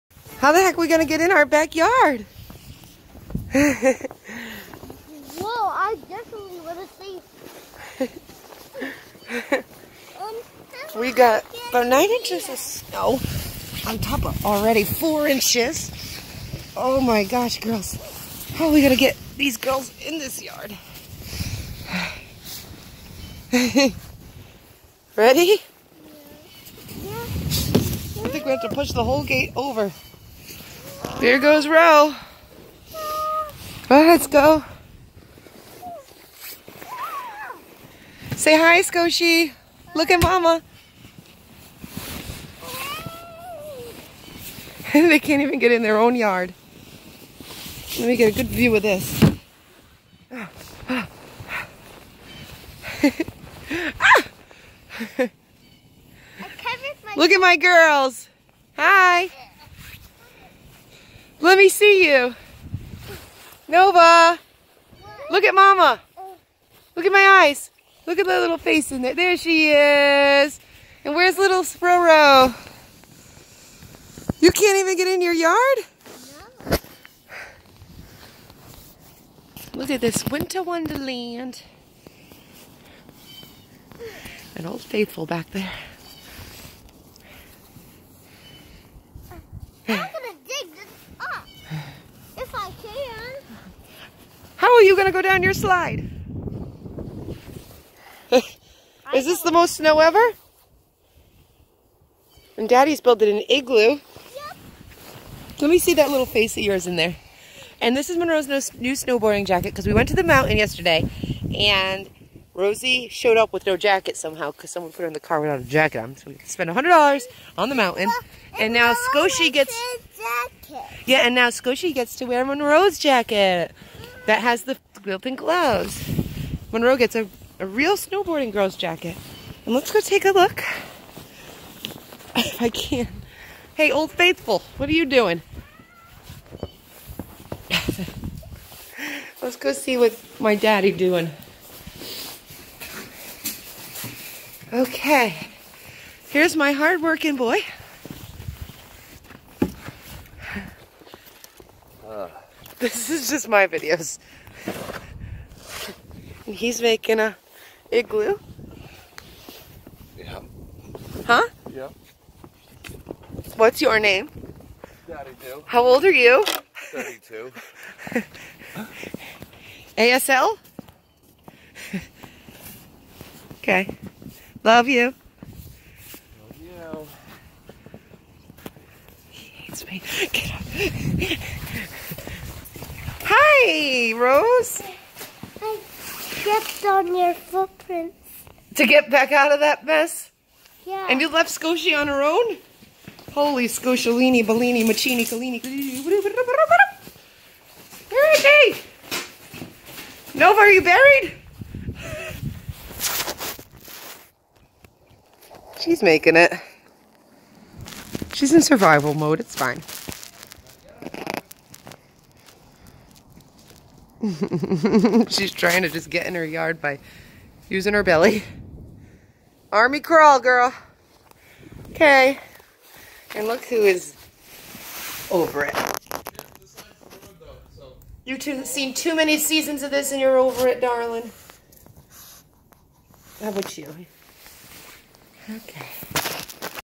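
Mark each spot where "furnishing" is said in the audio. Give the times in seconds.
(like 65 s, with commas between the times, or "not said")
not said.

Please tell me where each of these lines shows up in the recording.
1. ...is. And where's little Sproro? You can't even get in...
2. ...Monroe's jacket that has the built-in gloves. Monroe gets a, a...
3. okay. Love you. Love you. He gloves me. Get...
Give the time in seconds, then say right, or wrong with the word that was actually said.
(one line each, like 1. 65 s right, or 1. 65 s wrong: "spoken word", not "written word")
1. 69 s right
2. 122 s right
3. 173 s wrong: "hates", not "gloves".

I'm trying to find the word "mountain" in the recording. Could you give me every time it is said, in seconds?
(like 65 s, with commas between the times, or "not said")
110 s, 117 s.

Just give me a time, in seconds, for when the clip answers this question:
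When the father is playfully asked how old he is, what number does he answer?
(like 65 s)
166 s.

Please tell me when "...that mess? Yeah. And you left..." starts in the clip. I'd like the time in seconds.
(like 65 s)
189 s.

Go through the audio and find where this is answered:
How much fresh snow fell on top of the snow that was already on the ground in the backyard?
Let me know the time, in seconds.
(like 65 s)
11 s.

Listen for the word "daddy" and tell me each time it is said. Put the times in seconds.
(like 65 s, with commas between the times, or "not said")
102 s, 140 s, 165 s.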